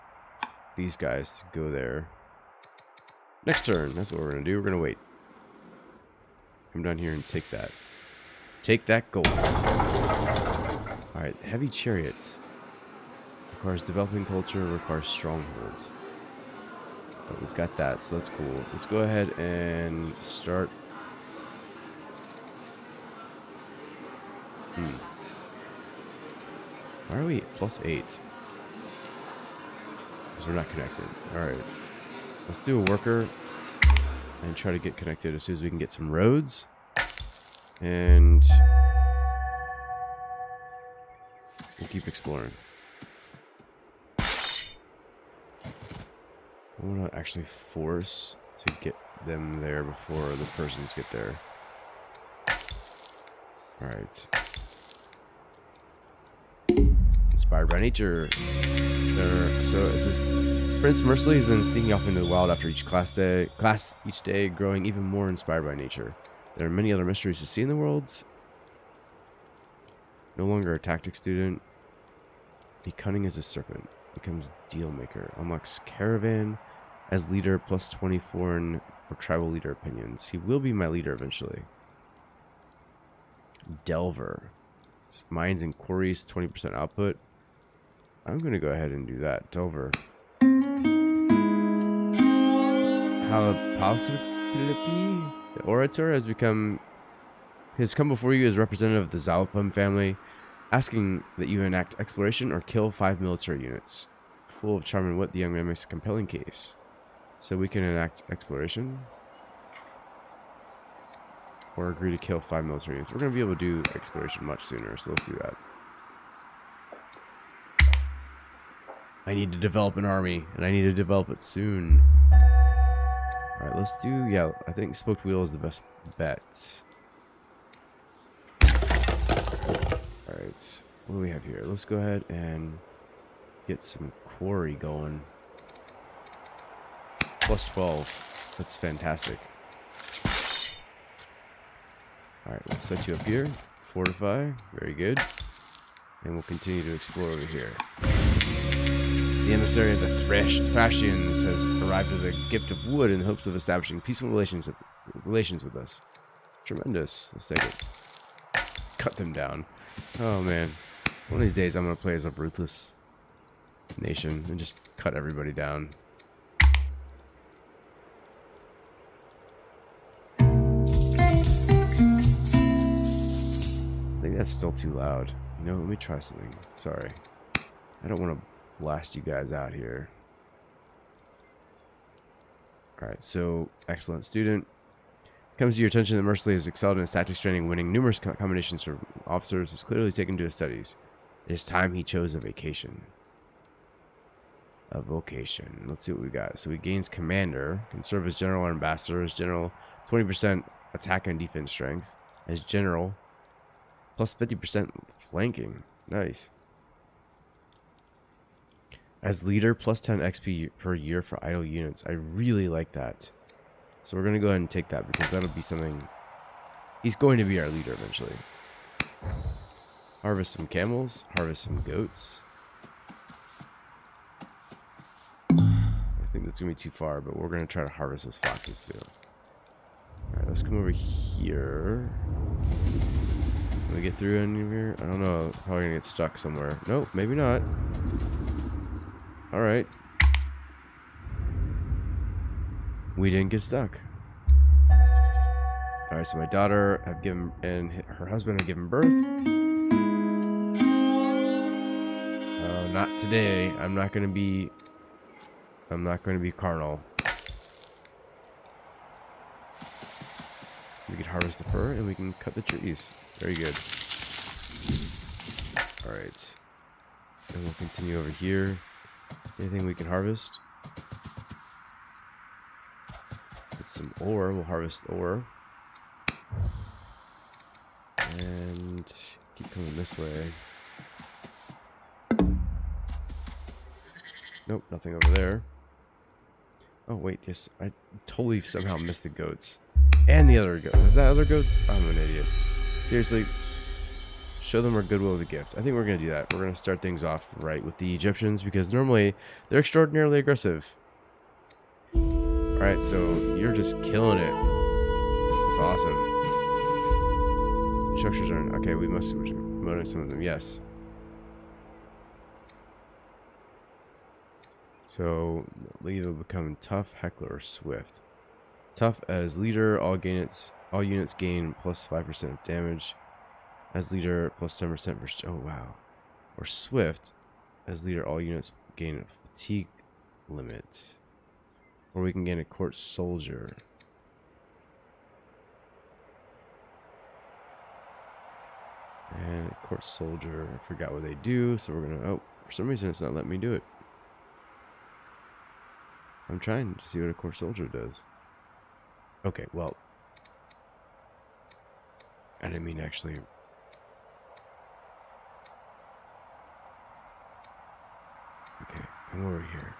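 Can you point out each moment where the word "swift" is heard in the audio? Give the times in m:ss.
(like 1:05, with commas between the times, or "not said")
5:17, 5:26.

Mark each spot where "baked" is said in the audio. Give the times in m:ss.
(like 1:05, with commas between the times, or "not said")
not said.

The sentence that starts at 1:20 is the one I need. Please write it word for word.
He will be my leader eventually.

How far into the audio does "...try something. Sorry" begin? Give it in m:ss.
2:55.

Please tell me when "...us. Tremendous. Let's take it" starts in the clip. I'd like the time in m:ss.
2:35.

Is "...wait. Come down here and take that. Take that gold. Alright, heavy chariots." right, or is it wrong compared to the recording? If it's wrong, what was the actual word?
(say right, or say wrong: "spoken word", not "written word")
right.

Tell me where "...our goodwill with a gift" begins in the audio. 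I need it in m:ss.
4:54.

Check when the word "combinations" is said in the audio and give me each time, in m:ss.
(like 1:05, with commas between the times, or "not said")
3:08.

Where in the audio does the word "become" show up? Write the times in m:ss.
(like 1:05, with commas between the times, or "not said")
1:14, 1:36, 5:16.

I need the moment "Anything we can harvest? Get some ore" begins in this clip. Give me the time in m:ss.
4:29.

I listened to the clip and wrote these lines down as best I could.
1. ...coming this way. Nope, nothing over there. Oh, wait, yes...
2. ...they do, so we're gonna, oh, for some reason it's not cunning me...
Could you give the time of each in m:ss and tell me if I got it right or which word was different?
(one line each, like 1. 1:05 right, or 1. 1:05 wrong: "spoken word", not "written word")
1. 4:39 right
2. 5:41 wrong: "letting", not "cunning".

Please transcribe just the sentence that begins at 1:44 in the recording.
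Full of charm and wit, the young man makes a compelling case.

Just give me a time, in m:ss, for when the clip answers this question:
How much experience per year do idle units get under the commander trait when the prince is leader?
3:29.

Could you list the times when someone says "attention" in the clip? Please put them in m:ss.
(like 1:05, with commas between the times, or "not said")
3:05.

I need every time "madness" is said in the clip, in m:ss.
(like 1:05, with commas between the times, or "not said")
not said.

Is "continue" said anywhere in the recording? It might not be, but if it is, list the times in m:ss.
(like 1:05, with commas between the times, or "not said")
2:26, 4:27.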